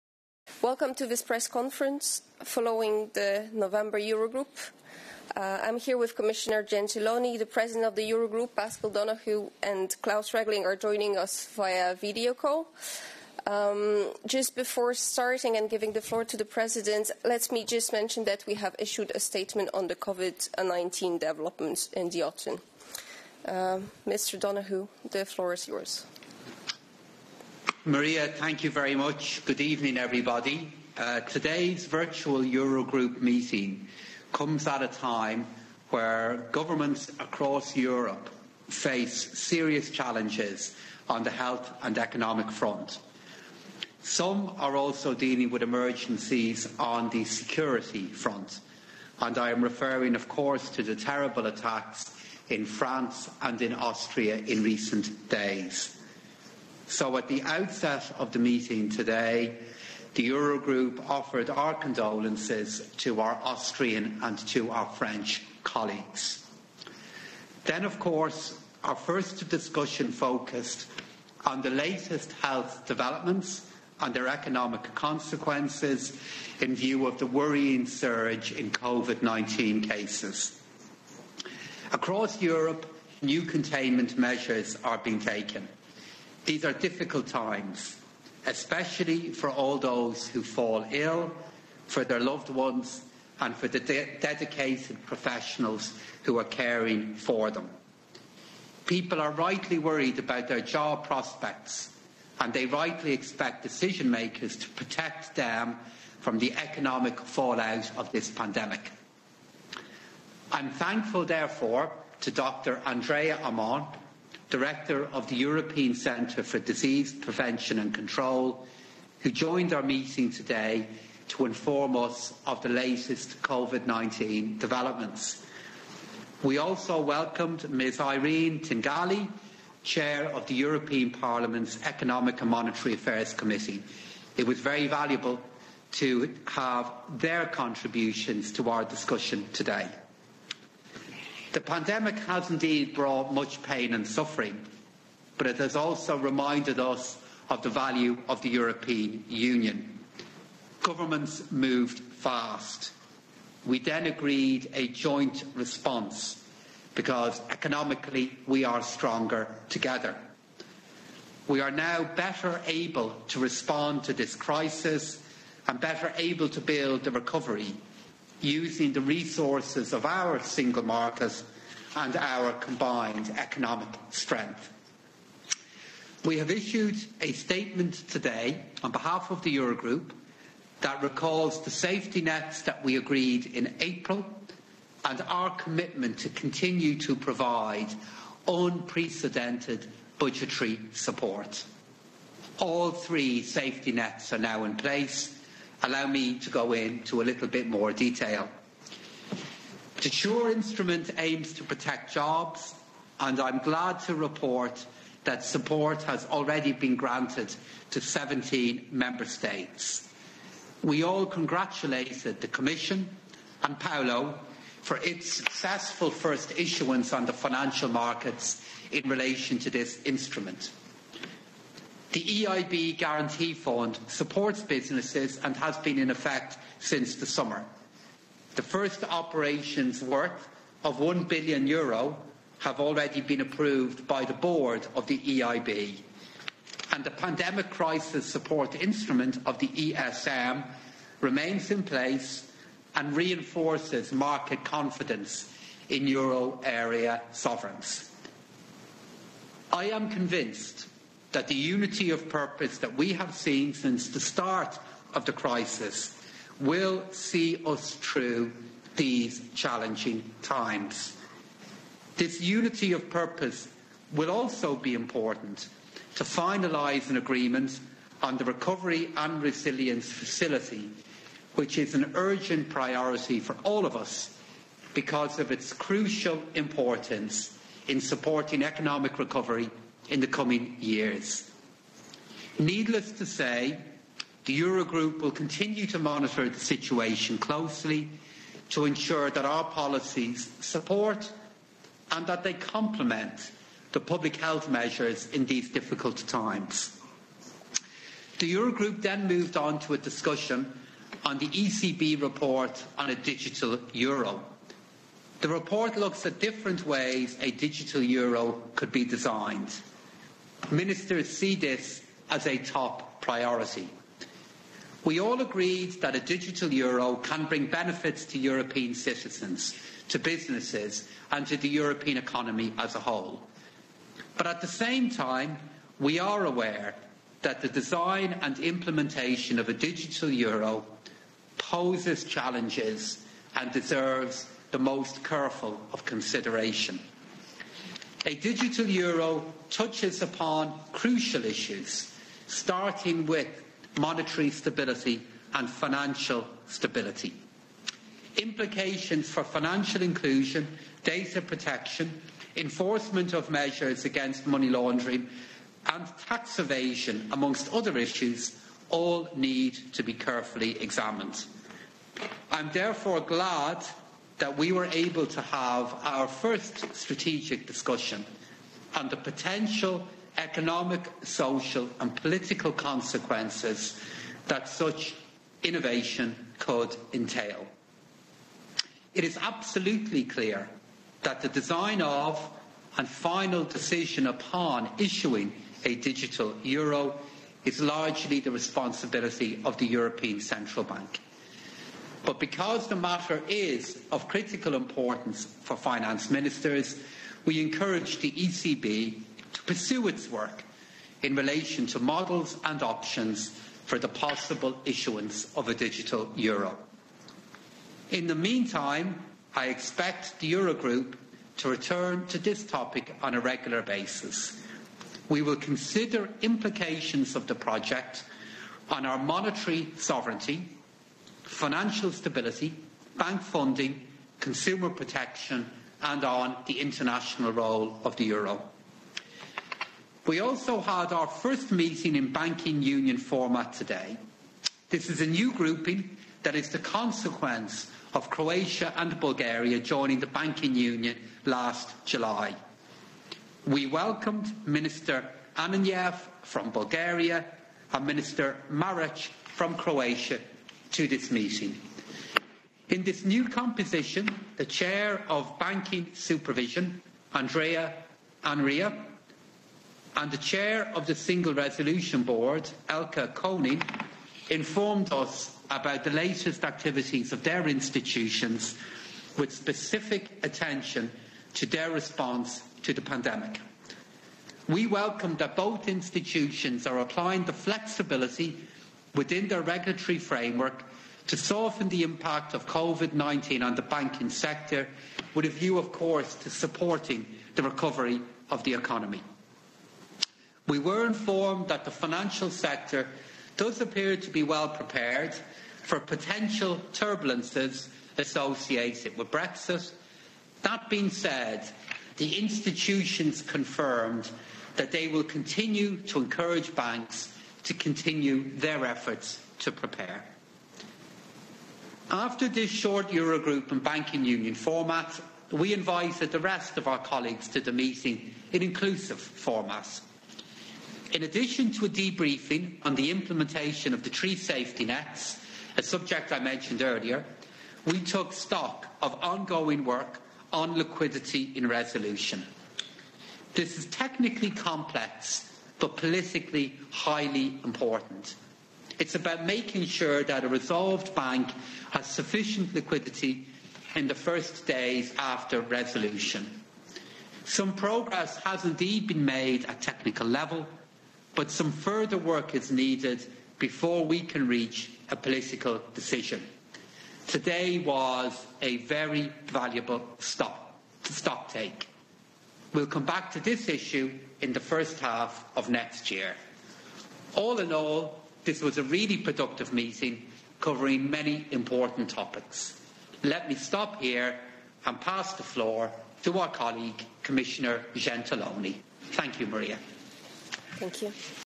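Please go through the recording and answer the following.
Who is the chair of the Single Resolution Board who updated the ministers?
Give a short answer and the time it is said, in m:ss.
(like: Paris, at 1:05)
Elke Koning, at 7:42.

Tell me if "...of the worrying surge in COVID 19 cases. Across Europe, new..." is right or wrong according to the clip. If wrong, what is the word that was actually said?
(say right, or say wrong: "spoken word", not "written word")
right.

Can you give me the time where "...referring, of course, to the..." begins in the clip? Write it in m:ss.
0:49.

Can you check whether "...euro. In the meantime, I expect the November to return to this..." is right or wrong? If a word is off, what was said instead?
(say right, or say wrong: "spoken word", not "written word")
wrong: "Eurogroup", not "November".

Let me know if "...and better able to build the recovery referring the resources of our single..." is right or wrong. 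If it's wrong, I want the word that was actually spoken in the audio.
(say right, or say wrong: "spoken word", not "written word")
wrong: "using", not "referring".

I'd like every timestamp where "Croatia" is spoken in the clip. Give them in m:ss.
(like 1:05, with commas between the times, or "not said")
7:18, 7:29.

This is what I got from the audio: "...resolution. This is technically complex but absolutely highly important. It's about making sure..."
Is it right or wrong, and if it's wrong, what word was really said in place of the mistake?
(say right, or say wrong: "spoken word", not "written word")
wrong: "politically", not "absolutely".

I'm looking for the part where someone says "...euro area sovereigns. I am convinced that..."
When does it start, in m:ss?
4:06.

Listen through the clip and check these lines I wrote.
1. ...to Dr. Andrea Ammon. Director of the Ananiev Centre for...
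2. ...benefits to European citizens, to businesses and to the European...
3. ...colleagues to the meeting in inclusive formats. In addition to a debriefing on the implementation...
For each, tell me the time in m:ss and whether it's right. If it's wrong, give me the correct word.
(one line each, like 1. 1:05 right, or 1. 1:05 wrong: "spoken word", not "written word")
1. 1:52 wrong: "European", not "Ananiev"
2. 5:17 right
3. 8:36 right.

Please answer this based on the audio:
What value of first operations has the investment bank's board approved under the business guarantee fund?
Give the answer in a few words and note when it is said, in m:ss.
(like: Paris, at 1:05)
1 billion euro, at 3:50.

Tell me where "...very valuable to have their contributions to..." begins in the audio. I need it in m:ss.
2:14.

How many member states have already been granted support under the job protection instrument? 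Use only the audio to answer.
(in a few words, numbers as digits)
17.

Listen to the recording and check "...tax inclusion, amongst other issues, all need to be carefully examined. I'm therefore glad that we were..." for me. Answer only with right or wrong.
wrong.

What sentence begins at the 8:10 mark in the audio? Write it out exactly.
We were informed that the financial sector does appear to be well prepared for potential turbulences associated with Brexit.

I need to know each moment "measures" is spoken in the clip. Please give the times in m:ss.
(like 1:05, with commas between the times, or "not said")
1:24, 4:54, 5:53.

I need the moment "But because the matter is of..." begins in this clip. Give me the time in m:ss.
6:32.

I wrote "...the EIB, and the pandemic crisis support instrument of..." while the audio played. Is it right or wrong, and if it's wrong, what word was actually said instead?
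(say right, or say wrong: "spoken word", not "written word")
right.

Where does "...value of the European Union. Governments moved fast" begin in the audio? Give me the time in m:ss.
2:27.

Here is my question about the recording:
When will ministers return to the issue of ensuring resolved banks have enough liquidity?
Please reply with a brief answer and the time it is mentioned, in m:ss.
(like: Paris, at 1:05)
first half of next year, at 9:24.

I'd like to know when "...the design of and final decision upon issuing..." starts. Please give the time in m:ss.
6:21.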